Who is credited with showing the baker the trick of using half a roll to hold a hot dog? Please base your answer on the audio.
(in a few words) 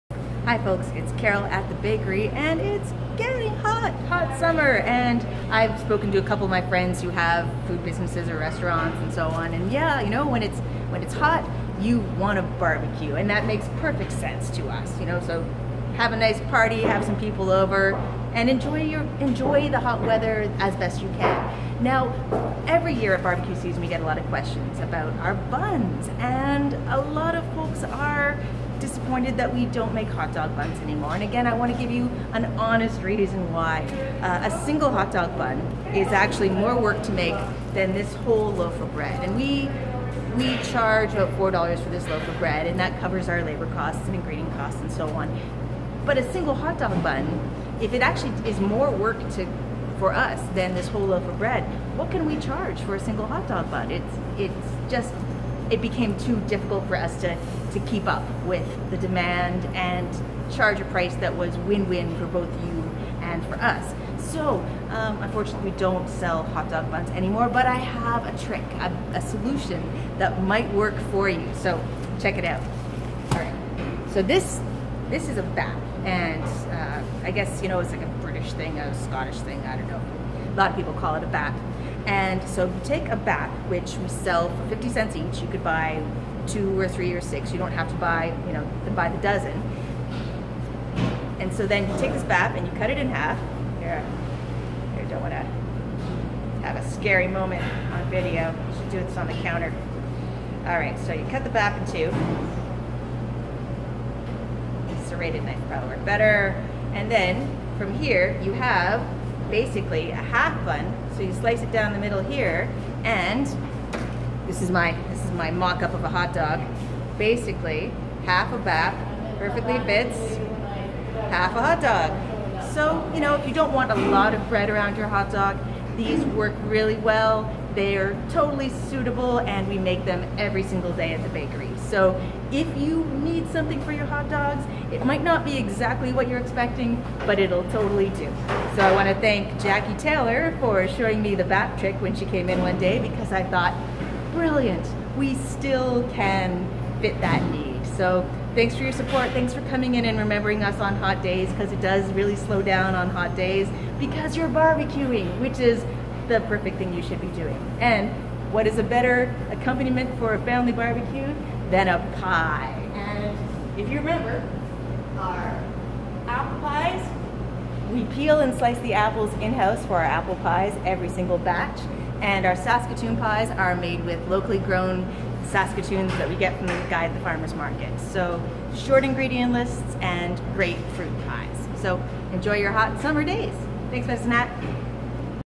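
Jackie Taylor.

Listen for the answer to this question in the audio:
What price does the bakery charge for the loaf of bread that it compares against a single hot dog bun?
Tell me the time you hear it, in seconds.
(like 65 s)
41 s.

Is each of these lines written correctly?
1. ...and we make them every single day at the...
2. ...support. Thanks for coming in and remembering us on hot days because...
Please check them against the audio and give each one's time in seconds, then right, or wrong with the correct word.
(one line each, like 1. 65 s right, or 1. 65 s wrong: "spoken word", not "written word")
1. 129 s right
2. 148 s right.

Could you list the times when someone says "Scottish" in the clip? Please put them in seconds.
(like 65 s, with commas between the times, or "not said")
79 s.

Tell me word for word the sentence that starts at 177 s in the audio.
So short ingredient lists and great fruit pies.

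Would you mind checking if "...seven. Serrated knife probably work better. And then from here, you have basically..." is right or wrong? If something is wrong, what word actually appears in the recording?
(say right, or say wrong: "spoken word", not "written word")
wrong: "two", not "seven".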